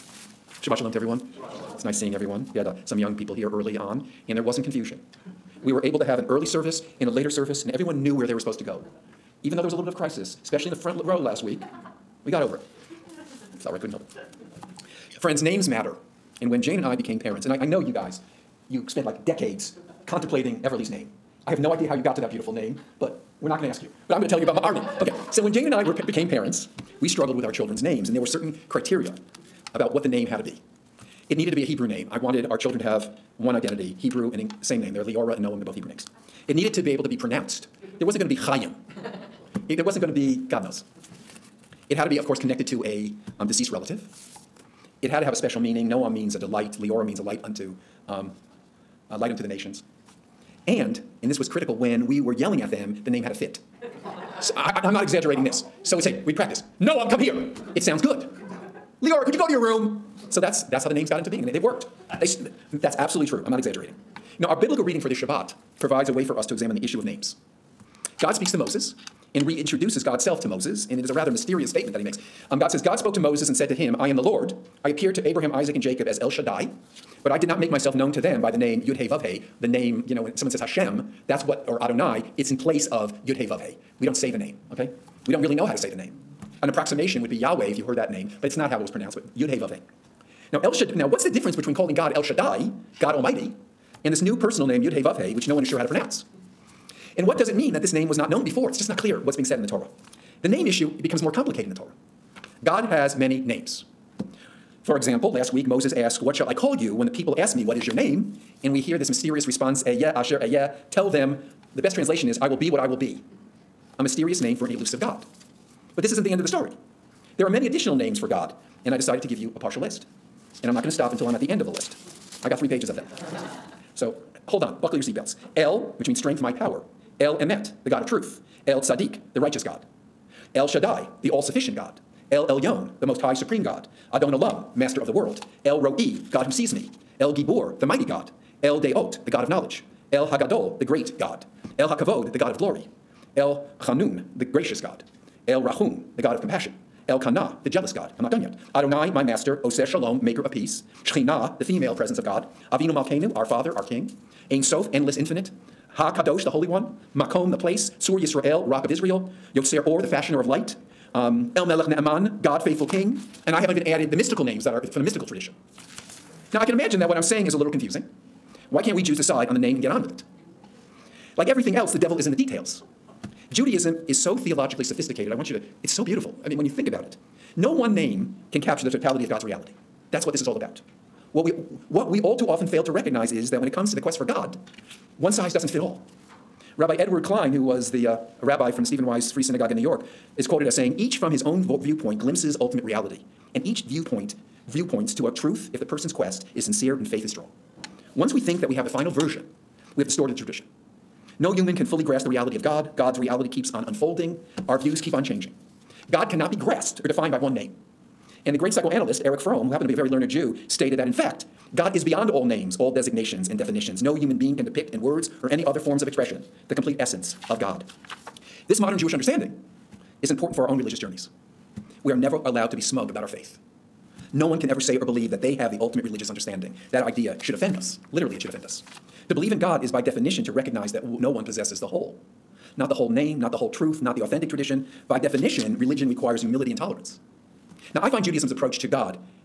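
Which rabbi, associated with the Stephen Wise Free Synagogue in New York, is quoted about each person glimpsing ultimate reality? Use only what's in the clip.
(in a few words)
Edward Klein.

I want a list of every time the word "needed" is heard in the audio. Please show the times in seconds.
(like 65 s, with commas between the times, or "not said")
31 s, 36 s.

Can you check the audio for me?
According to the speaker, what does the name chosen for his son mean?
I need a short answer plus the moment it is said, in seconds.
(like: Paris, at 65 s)
A delight, at 45 s.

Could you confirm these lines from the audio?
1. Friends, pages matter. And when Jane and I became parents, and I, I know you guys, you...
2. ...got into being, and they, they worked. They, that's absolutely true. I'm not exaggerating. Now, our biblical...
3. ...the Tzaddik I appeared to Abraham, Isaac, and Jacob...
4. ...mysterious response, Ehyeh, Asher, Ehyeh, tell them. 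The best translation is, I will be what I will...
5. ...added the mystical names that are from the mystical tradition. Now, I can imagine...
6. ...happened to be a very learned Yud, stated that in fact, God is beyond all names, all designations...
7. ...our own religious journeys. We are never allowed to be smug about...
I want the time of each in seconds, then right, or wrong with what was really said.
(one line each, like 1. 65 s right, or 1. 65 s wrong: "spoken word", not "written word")
1. 15 s wrong: "names", not "pages"
2. 61 s right
3. 74 s wrong: "Lord", not "Tzaddik"
4. 109 s right
5. 163 s right
6. 209 s wrong: "Jew", not "Yud"
7. 220 s right.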